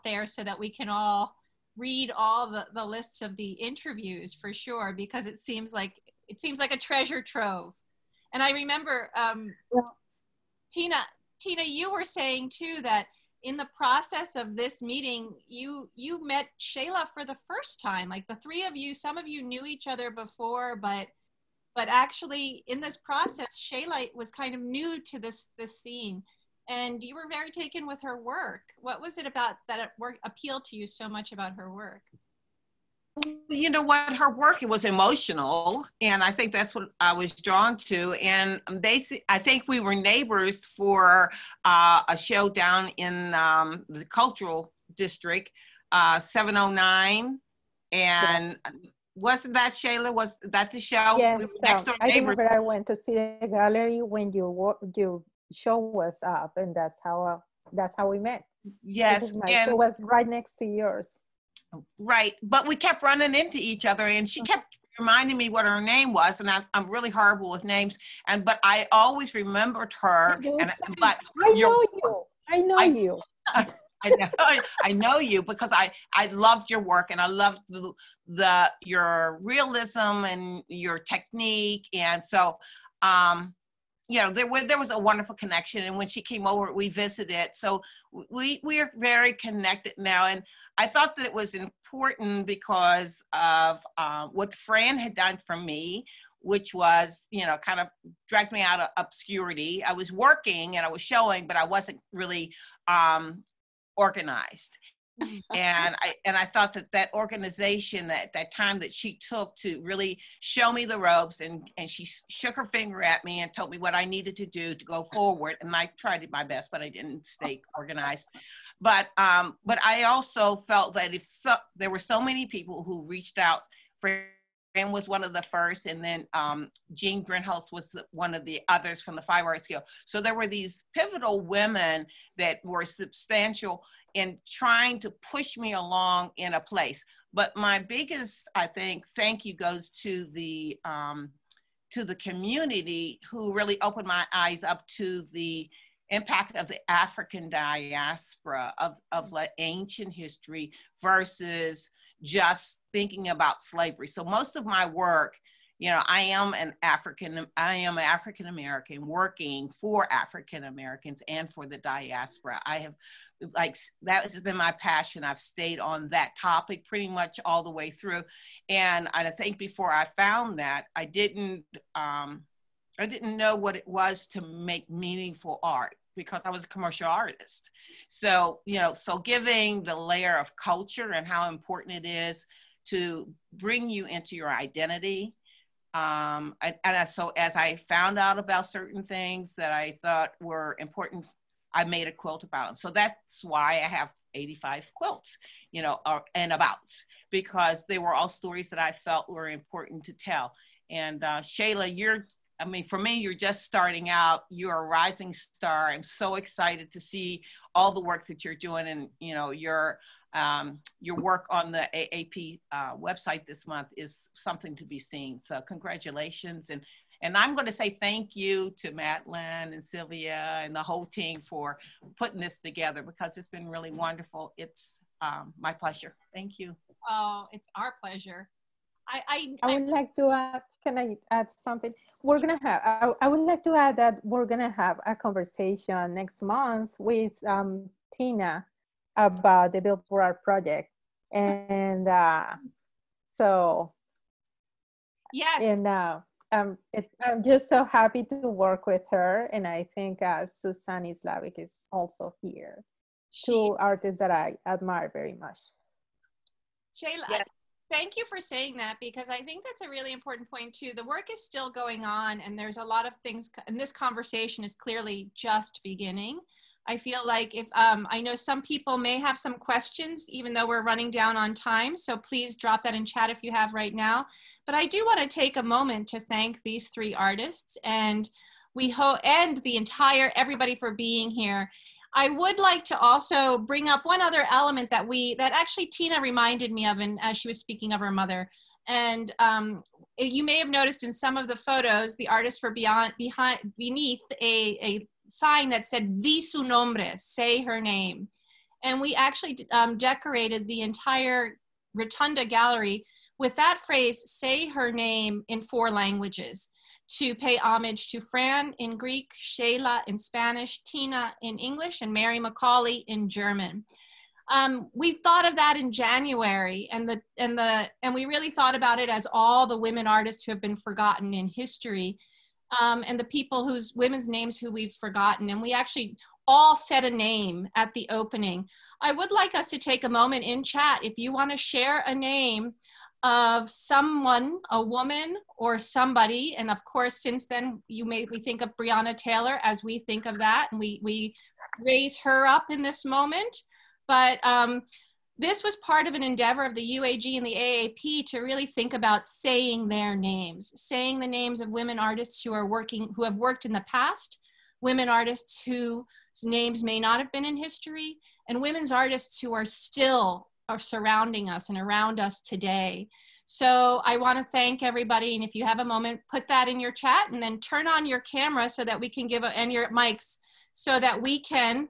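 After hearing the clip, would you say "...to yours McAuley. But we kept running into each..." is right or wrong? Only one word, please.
wrong.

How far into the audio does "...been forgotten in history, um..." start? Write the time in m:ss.
5:20.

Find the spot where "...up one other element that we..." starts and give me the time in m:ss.
4:43.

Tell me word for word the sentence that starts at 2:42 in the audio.
I have, like, that has been my passion.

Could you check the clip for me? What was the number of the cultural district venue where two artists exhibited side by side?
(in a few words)
709.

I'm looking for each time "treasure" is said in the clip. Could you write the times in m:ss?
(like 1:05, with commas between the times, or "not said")
0:06.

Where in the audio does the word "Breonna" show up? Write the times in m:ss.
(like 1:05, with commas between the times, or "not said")
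5:38.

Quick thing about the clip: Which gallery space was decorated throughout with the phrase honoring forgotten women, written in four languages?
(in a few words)
Rotunda Gallery.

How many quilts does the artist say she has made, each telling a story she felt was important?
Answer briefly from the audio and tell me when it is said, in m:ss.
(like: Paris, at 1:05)
85, at 3:14.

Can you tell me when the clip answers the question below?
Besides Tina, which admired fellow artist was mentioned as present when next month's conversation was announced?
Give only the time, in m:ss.
4:10.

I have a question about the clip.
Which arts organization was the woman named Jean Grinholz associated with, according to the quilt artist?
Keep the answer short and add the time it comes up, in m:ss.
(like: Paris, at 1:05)
Five Arts Guild, at 2:09.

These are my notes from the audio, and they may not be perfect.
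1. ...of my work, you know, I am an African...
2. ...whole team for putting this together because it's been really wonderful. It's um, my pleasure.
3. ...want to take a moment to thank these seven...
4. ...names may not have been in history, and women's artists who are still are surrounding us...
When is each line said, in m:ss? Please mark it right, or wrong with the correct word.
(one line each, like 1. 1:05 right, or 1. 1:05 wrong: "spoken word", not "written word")
1. 2:34 right
2. 3:40 right
3. 4:35 wrong: "three", not "seven"
4. 5:56 right.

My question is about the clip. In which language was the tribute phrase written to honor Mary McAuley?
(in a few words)
German.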